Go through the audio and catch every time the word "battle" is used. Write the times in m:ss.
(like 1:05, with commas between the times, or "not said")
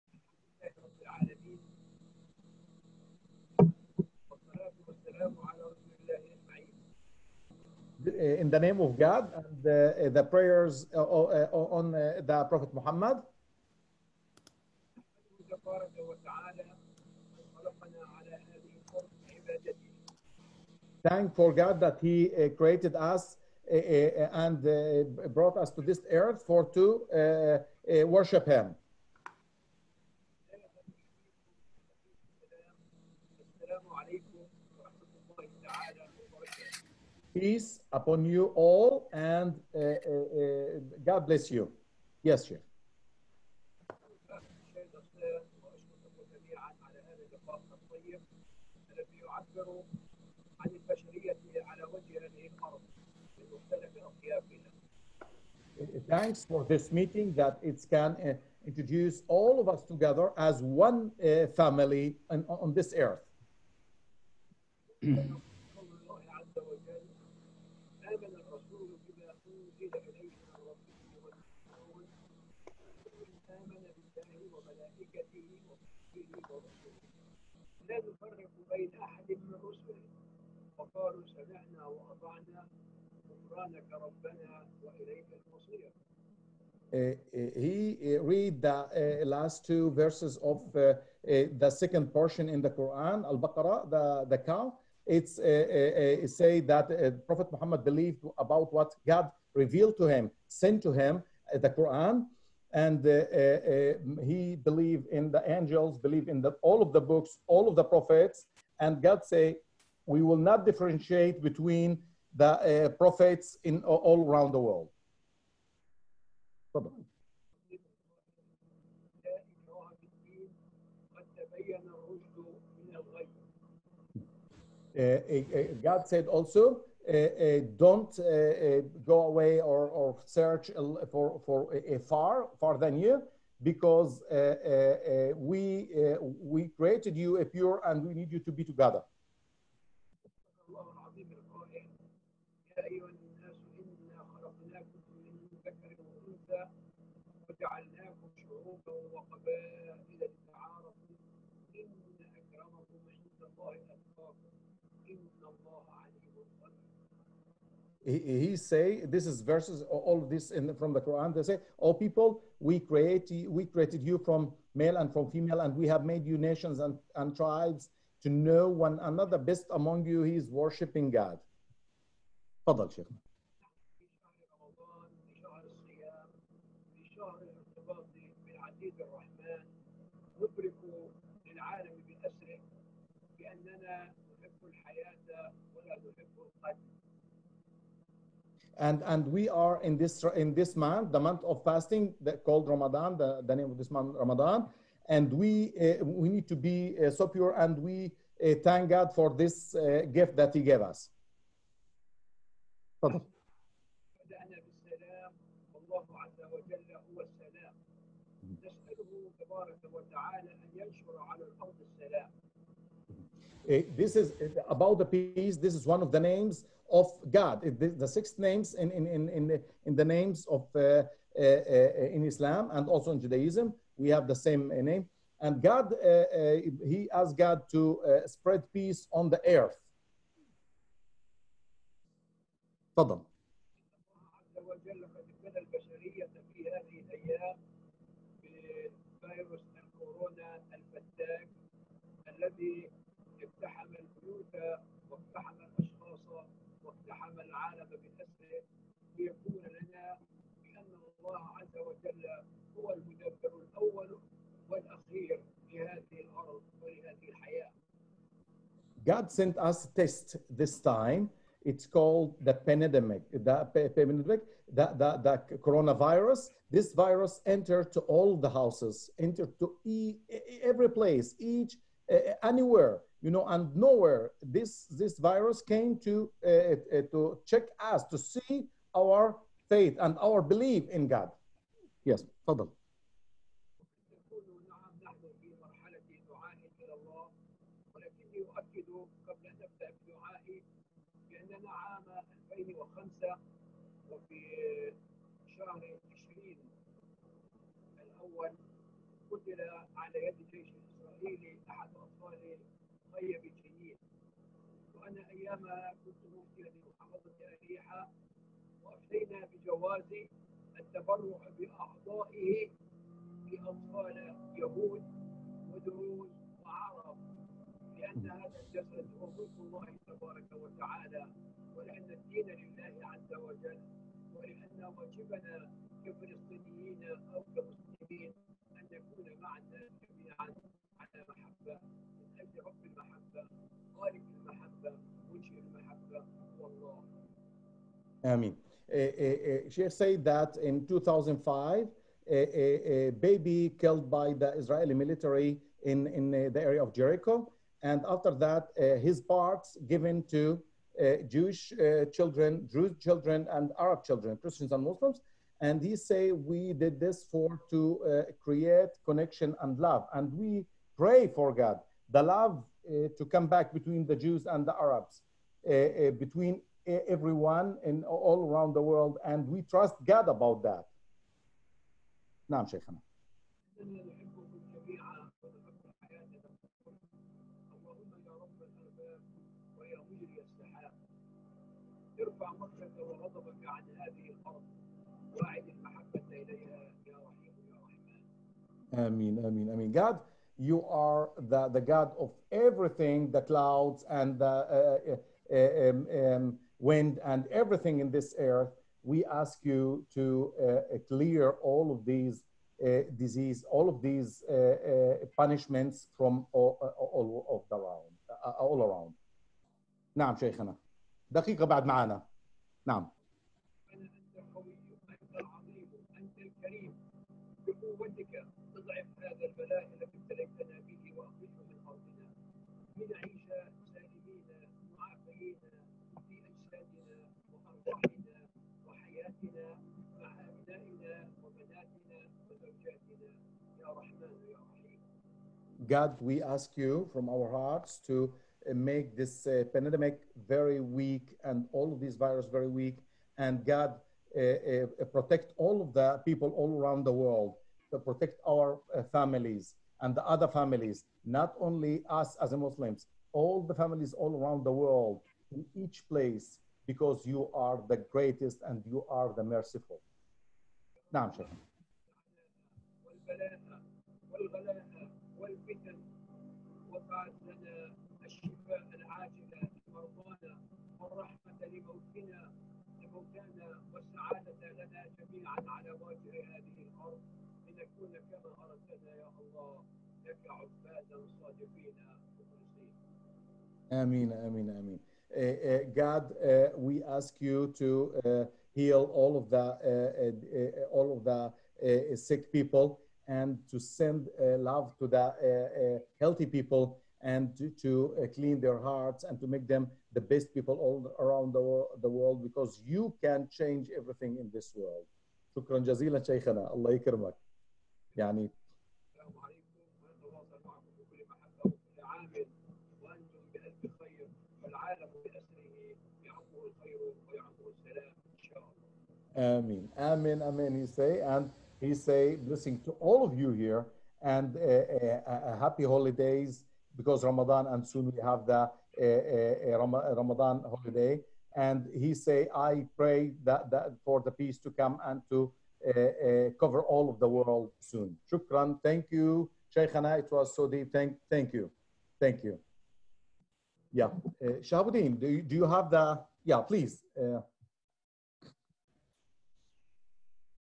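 not said.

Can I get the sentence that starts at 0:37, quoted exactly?
Peace upon you all, and uh, uh, uh God bless you.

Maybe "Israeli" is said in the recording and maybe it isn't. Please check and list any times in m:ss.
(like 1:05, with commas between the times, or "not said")
5:44.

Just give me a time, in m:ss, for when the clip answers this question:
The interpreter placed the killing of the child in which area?
5:46.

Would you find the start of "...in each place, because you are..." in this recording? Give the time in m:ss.
7:35.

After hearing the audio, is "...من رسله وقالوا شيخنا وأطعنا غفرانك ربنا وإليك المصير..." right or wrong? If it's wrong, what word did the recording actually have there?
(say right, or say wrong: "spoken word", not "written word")
wrong: "سمعنا", not "شيخنا".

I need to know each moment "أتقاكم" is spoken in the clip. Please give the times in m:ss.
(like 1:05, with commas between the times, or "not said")
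2:33.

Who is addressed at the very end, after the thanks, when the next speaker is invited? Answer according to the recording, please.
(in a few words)
Shahabuddin.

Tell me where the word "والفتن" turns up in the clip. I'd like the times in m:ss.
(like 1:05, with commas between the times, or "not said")
7:45.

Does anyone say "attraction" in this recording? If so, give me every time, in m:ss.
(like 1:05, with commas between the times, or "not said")
not said.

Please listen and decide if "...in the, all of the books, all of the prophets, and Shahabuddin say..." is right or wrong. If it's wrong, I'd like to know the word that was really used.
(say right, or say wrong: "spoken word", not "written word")
wrong: "God", not "Shahabuddin".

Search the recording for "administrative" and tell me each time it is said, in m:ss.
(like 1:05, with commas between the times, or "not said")
not said.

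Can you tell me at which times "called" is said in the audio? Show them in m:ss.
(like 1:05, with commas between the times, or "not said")
3:12, 4:21.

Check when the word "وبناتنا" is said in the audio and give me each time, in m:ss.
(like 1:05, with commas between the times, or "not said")
7:11.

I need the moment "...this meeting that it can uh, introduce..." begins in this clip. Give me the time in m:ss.
0:56.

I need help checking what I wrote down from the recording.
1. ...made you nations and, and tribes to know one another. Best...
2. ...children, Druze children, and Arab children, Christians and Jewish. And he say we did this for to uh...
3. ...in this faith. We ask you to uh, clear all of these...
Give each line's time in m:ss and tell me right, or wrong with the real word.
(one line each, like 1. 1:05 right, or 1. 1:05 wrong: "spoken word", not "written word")
1. 2:46 right
2. 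5:52 wrong: "Muslims", not "Jewish"
3. 6:38 wrong: "earth", not "faith".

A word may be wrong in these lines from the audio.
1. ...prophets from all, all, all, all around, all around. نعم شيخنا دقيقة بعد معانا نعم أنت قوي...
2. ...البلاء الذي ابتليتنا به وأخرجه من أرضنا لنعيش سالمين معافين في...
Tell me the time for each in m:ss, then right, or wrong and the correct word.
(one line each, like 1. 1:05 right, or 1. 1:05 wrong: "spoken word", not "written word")
1. 6:45 wrong: "punishments", not "prophets"
2. 6:59 right.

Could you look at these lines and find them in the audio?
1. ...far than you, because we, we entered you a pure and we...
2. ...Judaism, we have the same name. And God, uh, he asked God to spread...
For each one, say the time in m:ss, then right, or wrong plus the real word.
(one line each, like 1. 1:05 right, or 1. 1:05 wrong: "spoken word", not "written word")
1. 2:12 wrong: "created", not "entered"
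2. 3:43 right.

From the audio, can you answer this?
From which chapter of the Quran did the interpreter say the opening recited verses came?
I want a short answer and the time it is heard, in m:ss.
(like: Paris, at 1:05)
Al-Baqarah, at 1:33.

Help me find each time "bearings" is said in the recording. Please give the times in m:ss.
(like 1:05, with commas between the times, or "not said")
not said.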